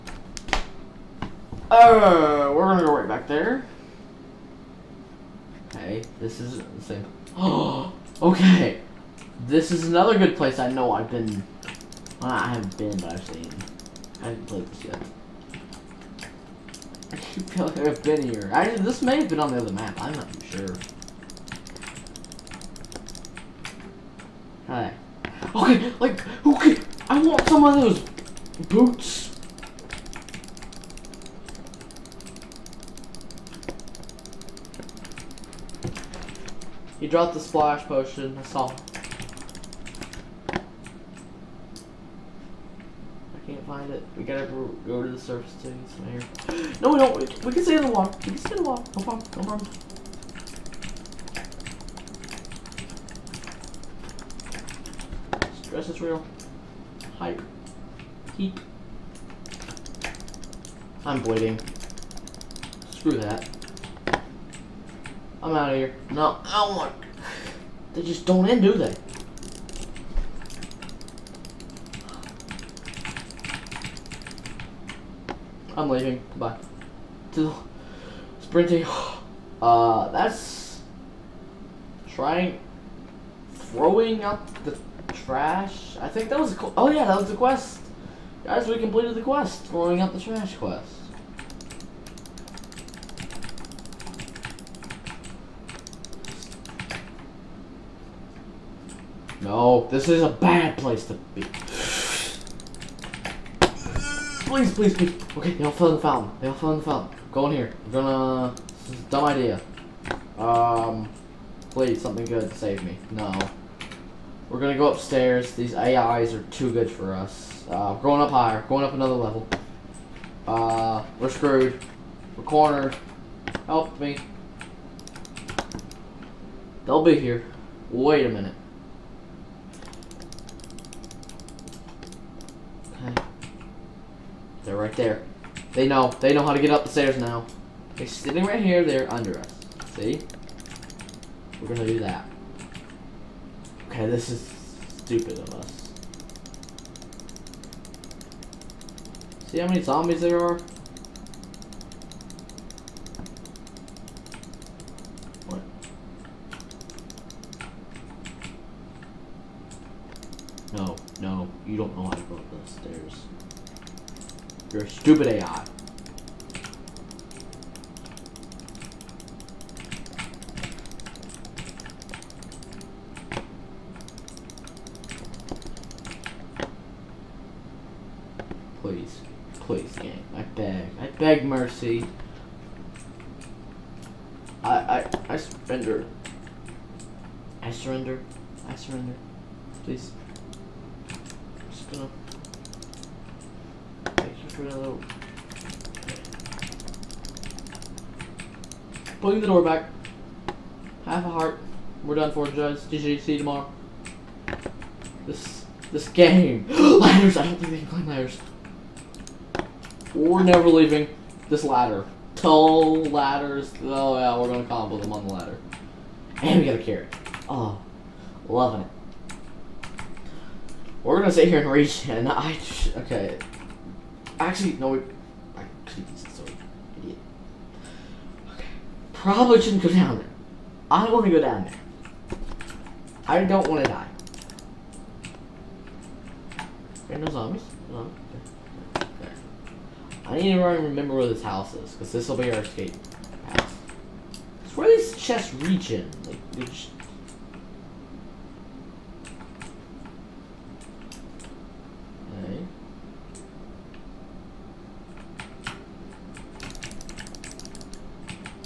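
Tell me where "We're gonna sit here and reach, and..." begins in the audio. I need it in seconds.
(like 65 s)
221 s.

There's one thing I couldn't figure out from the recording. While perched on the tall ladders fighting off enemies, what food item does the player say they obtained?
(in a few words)
A carrot.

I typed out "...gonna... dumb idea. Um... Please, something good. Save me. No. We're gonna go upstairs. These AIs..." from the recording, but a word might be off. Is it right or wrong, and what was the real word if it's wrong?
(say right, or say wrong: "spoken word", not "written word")
right.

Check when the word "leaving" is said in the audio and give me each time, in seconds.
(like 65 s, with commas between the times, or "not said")
75 s, 210 s.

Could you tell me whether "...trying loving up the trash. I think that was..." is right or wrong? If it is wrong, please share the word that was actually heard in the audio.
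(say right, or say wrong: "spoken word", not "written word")
wrong: "throwing", not "loving".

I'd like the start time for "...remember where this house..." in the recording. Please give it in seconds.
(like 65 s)
240 s.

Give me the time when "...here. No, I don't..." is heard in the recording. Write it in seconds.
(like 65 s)
65 s.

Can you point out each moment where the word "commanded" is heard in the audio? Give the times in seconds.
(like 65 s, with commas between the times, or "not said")
not said.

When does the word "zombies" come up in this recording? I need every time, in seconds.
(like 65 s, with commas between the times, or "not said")
149 s, 237 s.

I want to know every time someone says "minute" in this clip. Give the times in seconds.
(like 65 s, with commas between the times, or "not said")
128 s.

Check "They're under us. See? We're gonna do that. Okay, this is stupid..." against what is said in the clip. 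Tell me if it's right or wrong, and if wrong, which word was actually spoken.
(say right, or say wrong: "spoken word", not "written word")
right.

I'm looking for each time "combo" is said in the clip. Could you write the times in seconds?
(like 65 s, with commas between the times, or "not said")
214 s.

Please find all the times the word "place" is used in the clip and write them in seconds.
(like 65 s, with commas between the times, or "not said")
10 s, 100 s.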